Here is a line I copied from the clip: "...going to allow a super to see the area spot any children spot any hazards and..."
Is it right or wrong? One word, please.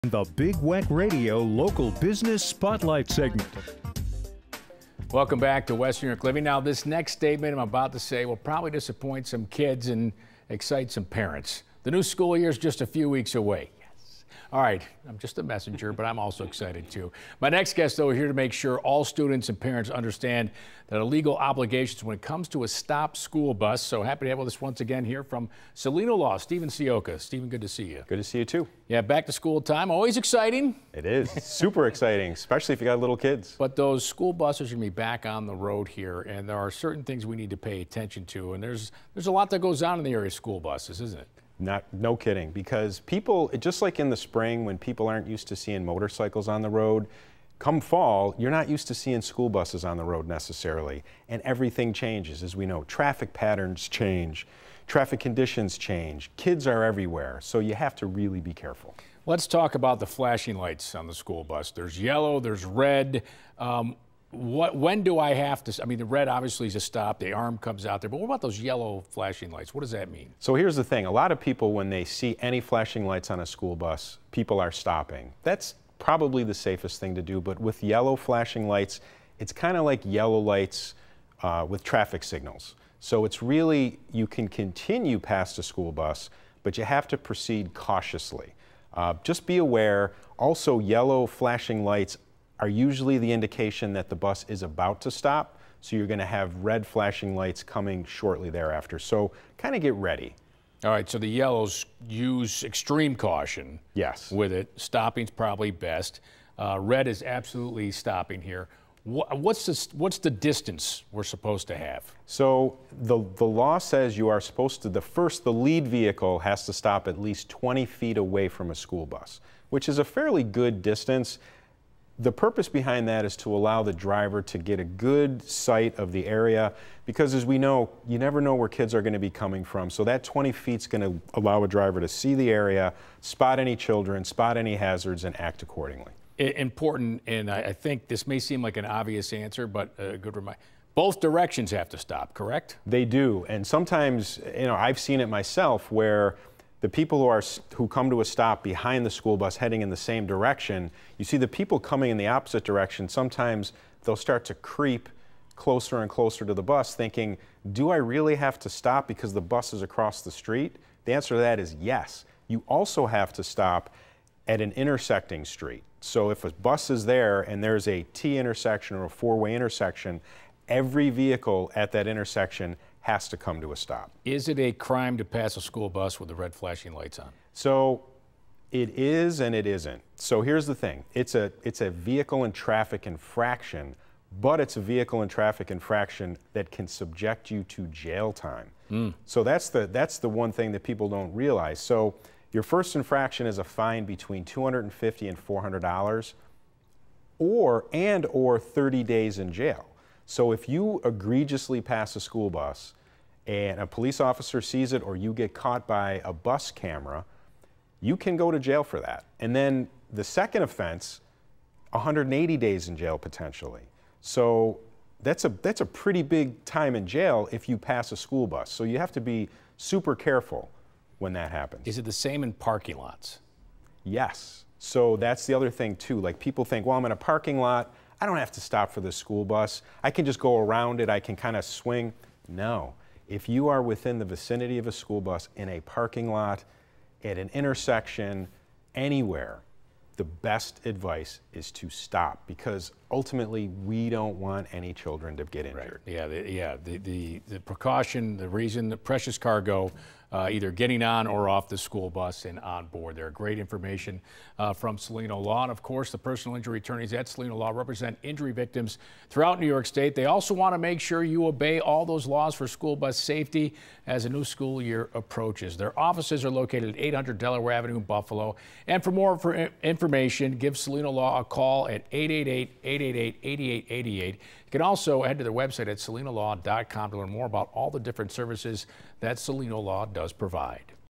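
wrong.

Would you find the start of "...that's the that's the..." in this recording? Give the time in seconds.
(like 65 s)
189 s.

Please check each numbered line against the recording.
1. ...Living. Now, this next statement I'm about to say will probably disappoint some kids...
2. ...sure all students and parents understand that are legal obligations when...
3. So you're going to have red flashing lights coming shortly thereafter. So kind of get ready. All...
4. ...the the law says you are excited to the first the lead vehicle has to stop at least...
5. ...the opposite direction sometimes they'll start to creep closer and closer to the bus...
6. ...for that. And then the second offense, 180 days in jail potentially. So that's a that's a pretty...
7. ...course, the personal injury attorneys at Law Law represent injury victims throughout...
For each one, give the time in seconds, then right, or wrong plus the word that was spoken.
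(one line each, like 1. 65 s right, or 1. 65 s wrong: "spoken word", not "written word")
1. 6 s right
2. 18 s right
3. 95 s right
4. 113 s wrong: "supposed", not "excited"
5. 152 s right
6. 208 s right
7. 255 s wrong: "Cellino", not "Law".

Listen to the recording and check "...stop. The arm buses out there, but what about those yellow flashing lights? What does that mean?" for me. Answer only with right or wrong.
wrong.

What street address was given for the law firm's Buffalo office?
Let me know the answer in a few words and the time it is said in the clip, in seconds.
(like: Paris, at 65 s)
800 Delaware Avenue, at 266 s.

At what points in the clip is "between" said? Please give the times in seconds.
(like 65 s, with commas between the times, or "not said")
194 s.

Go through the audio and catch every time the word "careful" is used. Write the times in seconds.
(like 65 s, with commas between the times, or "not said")
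58 s, 220 s.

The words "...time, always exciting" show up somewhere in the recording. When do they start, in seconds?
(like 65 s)
29 s.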